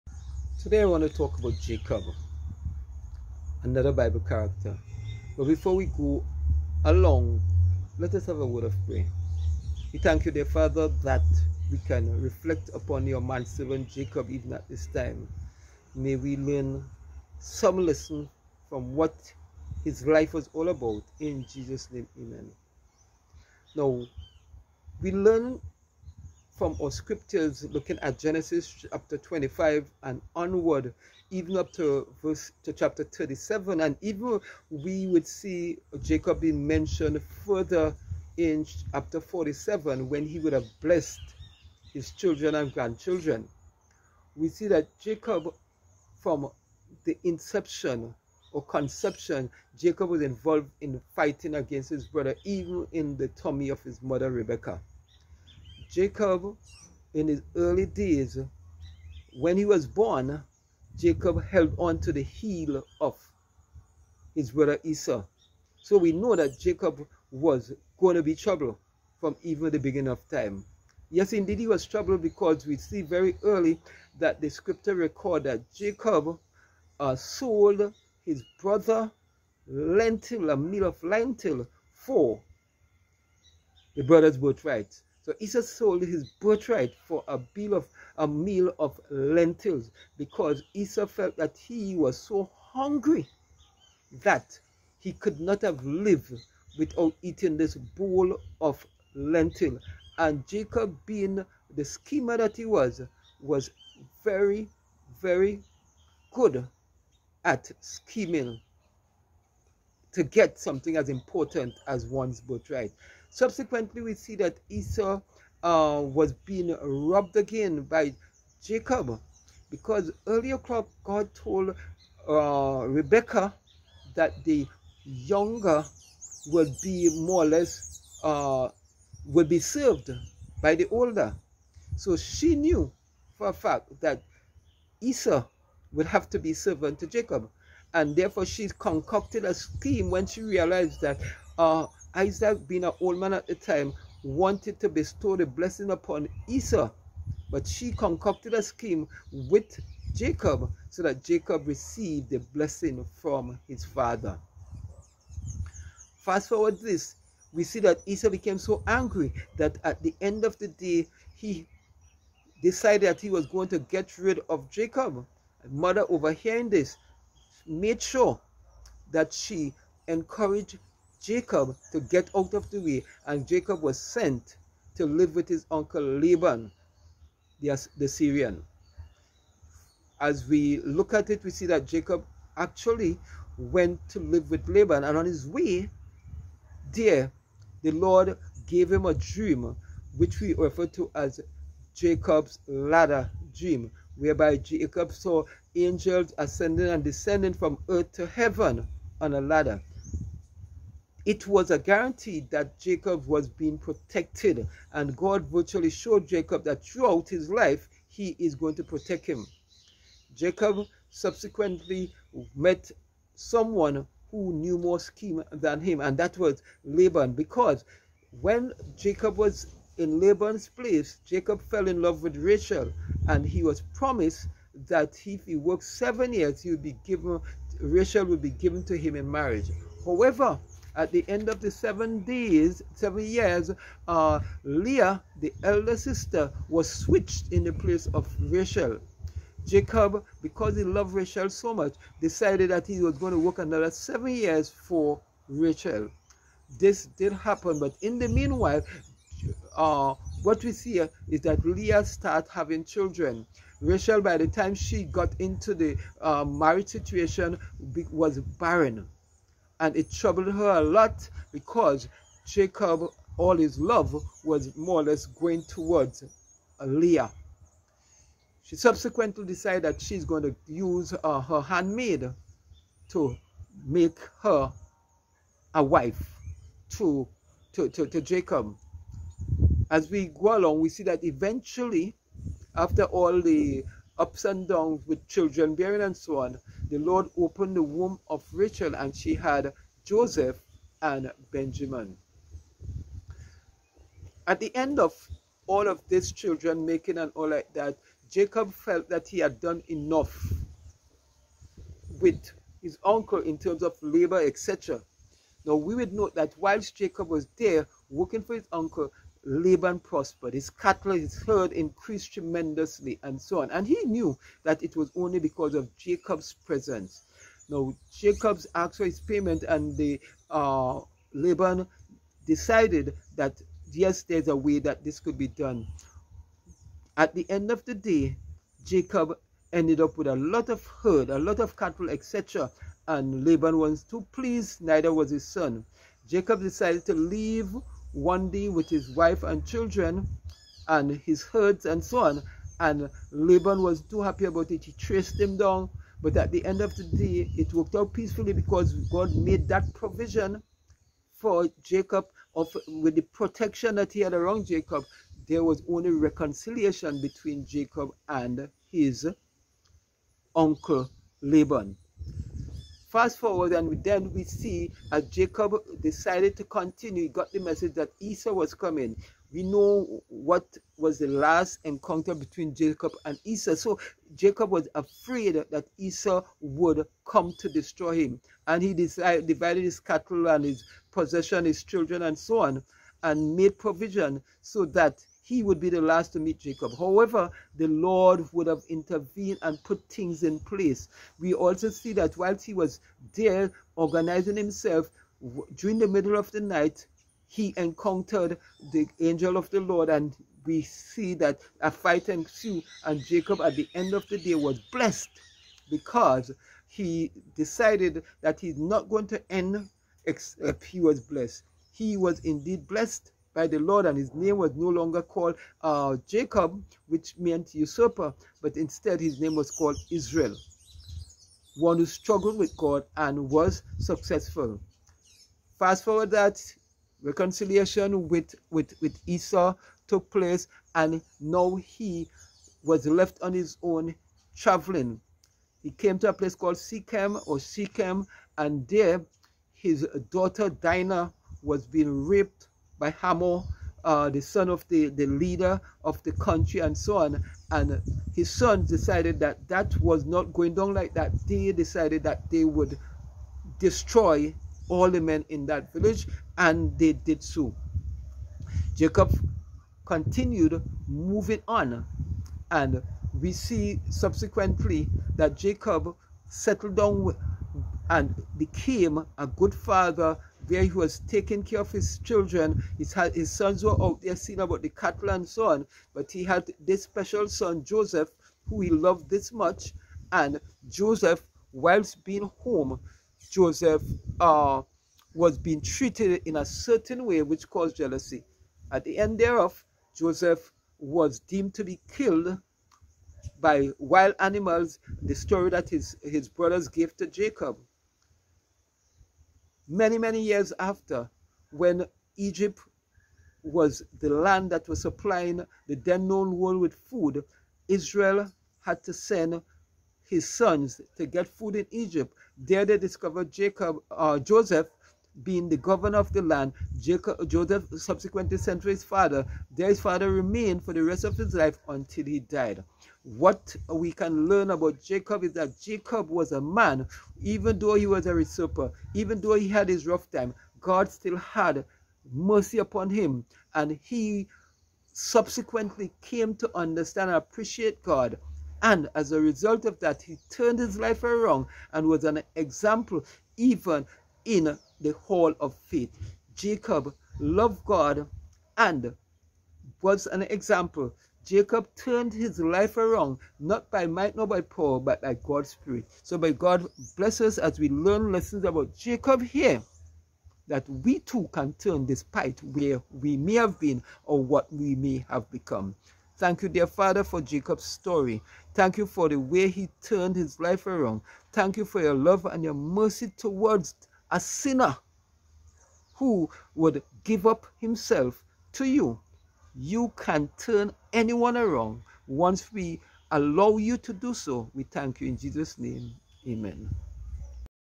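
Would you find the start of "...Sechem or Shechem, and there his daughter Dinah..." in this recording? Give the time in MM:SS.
07:16.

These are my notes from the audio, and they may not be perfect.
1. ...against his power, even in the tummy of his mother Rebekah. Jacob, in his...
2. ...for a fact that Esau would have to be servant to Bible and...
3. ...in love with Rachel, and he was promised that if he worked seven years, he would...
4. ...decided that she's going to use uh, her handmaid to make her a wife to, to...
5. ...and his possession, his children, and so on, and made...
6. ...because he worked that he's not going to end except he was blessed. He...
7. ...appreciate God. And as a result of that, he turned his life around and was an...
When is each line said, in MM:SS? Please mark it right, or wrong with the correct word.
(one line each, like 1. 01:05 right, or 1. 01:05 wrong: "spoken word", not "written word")
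1. 00:51 wrong: "brother", not "power"
2. 02:13 wrong: "Jacob", not "Bible"
3. 03:41 right
4. 04:29 right
5. 06:20 right
6. 06:45 wrong: "decided", not "worked"
7. 08:57 right.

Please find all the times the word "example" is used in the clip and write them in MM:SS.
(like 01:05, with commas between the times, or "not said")
09:02, 09:10.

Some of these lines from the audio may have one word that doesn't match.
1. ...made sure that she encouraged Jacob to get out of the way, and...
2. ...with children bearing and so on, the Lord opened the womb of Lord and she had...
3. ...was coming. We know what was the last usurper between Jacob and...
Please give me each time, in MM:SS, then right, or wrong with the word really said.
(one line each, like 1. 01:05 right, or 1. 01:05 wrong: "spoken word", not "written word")
1. 02:47 right
2. 04:45 wrong: "Rachel", not "Lord"
3. 06:08 wrong: "encounter", not "usurper".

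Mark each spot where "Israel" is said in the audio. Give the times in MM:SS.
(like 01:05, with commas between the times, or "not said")
07:00, 08:27.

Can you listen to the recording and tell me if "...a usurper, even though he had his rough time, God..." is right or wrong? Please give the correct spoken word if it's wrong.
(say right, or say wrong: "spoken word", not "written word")
right.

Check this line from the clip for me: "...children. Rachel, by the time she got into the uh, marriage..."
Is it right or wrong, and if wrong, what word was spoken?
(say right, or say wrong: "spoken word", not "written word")
right.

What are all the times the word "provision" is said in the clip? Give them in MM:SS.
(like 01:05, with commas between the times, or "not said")
05:49, 06:23.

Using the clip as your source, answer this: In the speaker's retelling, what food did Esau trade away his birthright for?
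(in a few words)
A meal of lentils.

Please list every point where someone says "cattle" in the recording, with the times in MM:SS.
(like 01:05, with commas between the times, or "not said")
05:10, 05:31, 06:19, 07:54.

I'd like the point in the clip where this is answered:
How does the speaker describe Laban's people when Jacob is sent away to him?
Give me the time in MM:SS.
02:57.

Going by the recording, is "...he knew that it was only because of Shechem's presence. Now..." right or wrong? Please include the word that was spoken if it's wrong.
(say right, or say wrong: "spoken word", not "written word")
wrong: "Jacob", not "Shechem".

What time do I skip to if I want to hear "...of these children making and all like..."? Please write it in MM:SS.
04:55.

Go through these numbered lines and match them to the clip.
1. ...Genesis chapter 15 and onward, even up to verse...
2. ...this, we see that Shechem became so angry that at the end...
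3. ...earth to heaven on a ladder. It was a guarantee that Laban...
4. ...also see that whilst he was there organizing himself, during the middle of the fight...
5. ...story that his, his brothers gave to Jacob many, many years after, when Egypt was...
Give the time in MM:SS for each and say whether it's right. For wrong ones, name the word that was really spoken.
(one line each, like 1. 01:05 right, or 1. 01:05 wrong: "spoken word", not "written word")
1. 00:28 wrong: "25", not "15"
2. 02:36 wrong: "Esau", not "Shechem"
3. 03:17 wrong: "Jacob", not "Laban"
4. 06:31 wrong: "night", not "fight"
5. 08:15 right.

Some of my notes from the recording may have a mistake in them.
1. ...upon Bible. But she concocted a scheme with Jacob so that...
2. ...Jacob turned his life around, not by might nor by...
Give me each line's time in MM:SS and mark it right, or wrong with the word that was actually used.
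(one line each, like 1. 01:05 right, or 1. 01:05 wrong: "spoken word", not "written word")
1. 02:25 wrong: "Esau", not "Bible"
2. 09:11 right.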